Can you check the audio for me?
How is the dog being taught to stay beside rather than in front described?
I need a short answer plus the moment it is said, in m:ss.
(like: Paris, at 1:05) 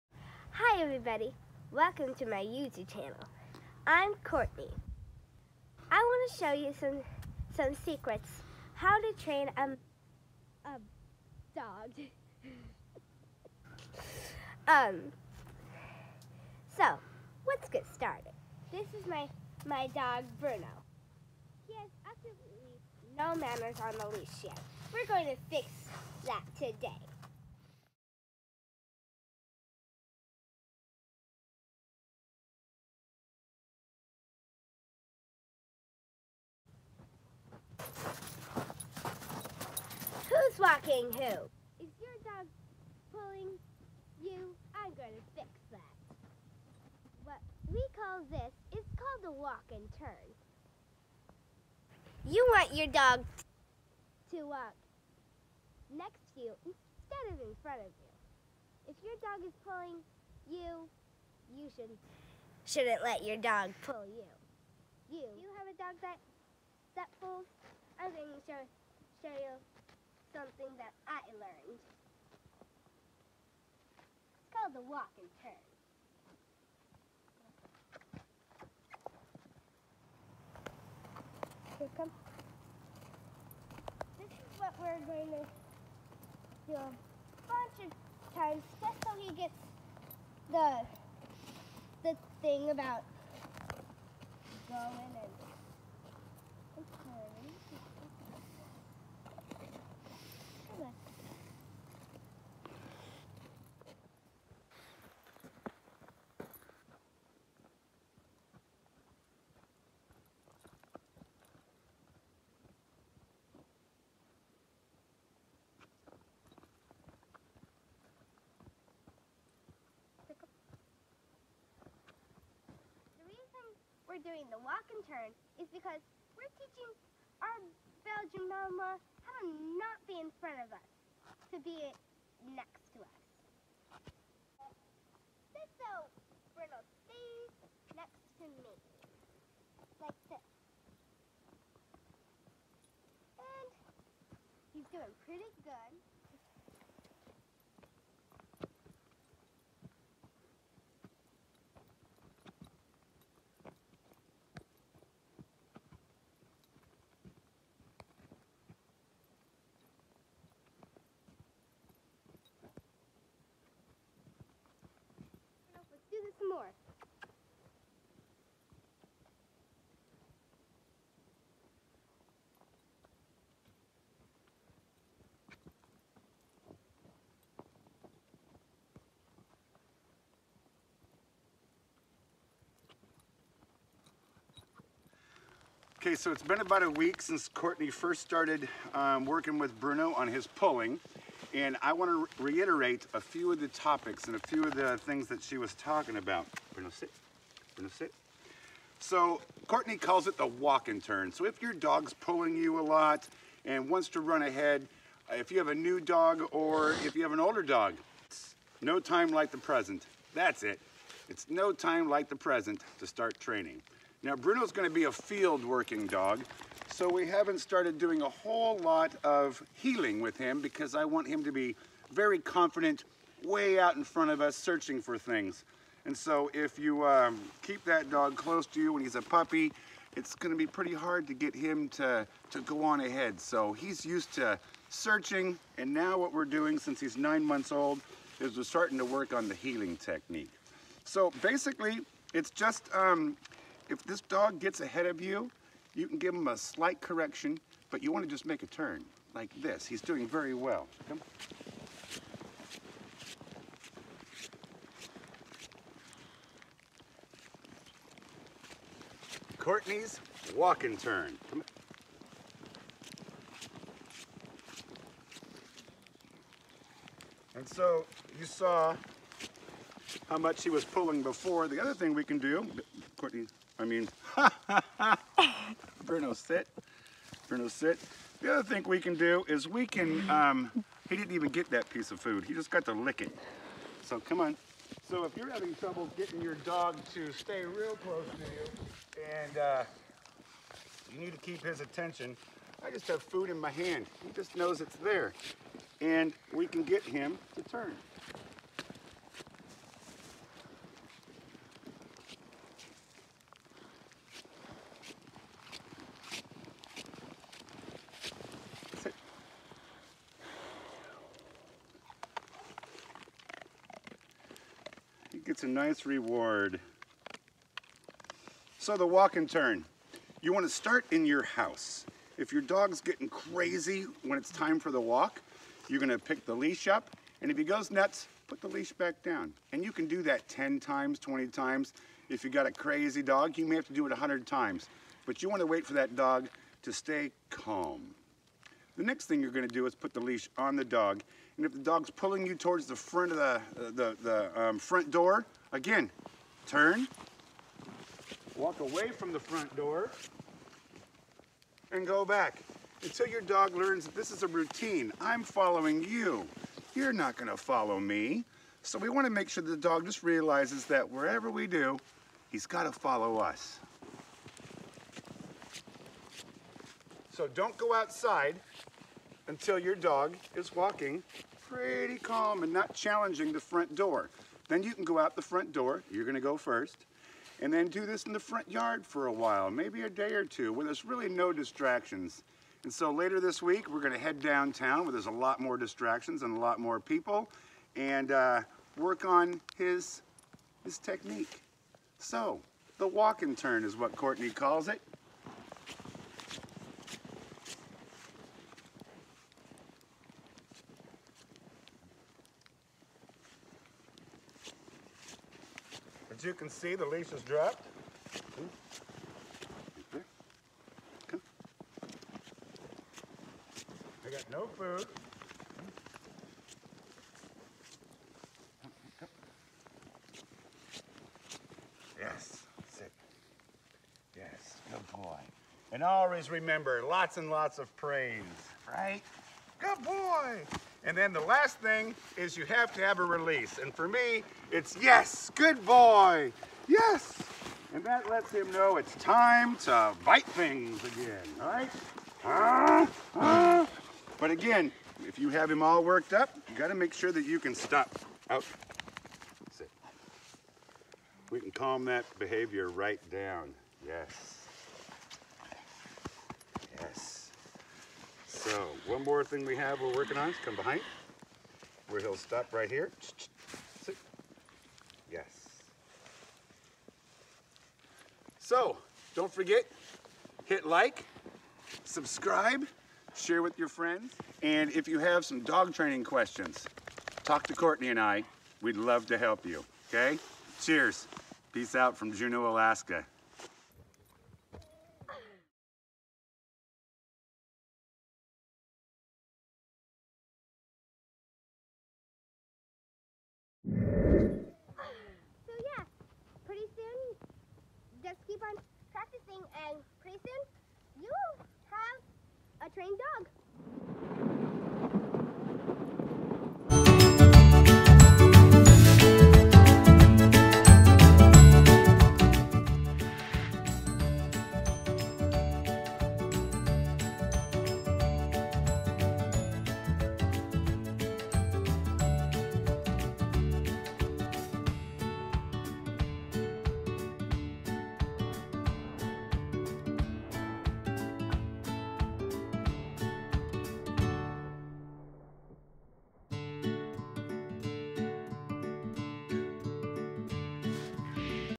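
Belgian, at 2:08.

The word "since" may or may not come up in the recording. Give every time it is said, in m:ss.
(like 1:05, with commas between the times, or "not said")
3:07, 3:56.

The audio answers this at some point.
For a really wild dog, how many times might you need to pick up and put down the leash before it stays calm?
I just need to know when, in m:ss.
5:34.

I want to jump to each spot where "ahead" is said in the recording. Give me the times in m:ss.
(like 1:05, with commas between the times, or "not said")
3:24, 3:53, 4:04.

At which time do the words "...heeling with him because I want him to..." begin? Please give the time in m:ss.
3:39.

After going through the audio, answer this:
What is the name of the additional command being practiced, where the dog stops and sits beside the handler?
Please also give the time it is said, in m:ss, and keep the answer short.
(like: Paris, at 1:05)
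come behind, at 7:40.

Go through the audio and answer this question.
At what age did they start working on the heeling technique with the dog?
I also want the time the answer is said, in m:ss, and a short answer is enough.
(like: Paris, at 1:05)
9 months, at 3:57.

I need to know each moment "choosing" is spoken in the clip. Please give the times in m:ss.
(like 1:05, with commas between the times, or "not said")
not said.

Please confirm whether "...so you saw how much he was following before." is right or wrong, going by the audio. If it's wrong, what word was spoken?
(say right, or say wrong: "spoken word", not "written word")
wrong: "pulling", not "following".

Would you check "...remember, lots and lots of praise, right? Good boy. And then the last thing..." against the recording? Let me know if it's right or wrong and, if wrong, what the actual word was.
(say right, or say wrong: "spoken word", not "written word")
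right.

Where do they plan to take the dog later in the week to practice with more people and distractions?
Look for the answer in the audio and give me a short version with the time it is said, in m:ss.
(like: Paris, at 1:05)
downtown, at 6:24.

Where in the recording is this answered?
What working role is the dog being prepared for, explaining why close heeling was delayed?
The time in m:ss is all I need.
3:35.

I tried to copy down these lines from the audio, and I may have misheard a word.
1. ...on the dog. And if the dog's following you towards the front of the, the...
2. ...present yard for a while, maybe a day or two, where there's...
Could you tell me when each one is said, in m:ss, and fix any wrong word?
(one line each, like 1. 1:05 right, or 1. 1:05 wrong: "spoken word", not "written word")
1. 5:40 wrong: "pulling", not "following"
2. 6:18 wrong: "front", not "present".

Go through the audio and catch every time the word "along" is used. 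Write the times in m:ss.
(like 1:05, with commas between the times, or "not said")
not said.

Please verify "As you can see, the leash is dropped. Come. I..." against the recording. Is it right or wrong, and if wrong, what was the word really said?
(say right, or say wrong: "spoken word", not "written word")
right.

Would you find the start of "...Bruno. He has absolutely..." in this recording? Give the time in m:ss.
0:20.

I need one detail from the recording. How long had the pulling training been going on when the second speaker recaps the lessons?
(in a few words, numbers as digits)
about a week.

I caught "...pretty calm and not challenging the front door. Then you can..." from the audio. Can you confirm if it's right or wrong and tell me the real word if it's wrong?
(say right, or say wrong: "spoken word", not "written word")
right.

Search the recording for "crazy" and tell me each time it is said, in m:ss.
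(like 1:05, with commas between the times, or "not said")
5:23, 5:32.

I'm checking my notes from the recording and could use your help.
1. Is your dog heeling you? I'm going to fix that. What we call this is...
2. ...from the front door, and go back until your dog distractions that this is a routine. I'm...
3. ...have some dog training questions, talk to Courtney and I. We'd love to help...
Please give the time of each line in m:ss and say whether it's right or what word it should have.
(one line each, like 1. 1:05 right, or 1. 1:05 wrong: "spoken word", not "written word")
1. 0:41 wrong: "pulling", not "heeling"
2. 5:49 wrong: "learns", not "distractions"
3. 7:55 right.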